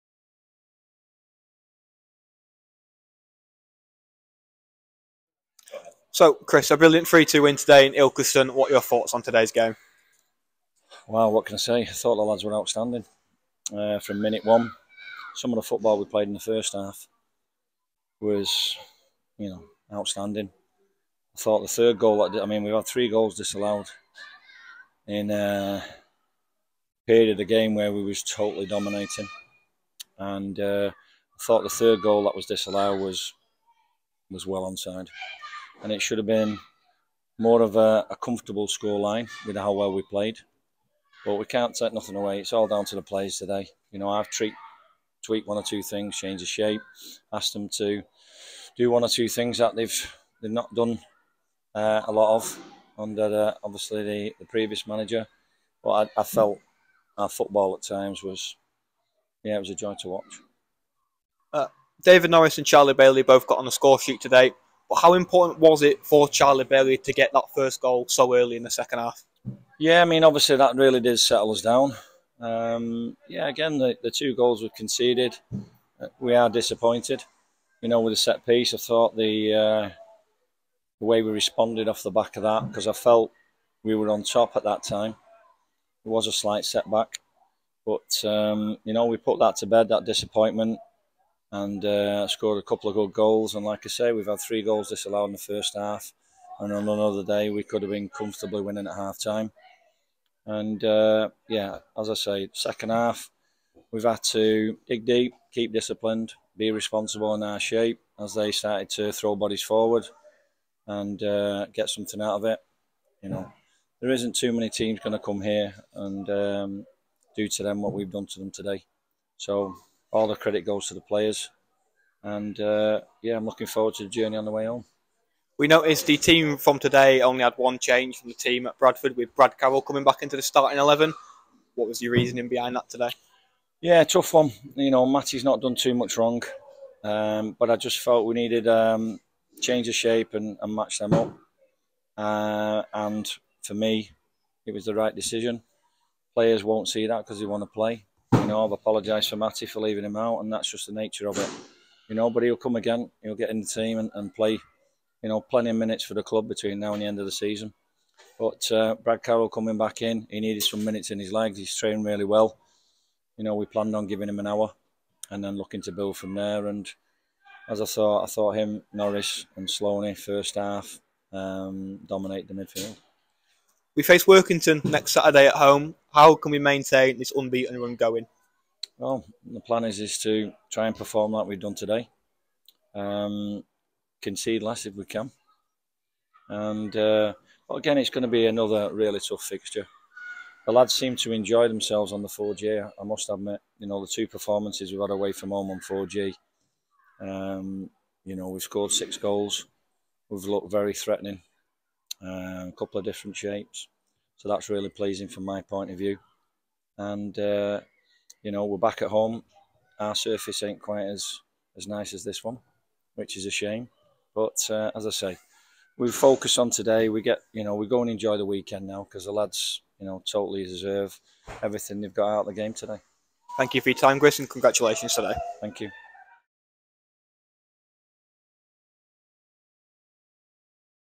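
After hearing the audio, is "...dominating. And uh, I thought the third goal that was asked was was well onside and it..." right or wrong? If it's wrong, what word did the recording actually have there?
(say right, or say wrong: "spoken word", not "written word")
wrong: "disallowed", not "asked".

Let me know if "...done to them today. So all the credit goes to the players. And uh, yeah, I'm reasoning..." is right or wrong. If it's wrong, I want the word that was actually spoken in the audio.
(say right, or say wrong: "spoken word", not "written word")
wrong: "looking", not "reasoning".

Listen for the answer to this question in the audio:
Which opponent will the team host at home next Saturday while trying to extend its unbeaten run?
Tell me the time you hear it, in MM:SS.
02:54.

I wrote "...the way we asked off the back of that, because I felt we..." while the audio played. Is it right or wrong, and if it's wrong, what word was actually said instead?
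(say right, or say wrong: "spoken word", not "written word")
wrong: "responded", not "asked".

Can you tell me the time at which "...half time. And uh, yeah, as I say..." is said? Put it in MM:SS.
01:38.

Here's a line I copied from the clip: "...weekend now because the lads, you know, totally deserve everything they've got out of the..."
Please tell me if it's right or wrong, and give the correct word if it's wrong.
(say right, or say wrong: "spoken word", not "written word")
right.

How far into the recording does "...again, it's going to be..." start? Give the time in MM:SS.
03:07.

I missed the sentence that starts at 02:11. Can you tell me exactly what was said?
What was your reasoning behind that today?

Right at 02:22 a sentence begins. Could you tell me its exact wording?
Uh, and for me, it was the right decision.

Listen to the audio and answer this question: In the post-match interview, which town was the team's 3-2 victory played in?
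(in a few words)
Ilkeston.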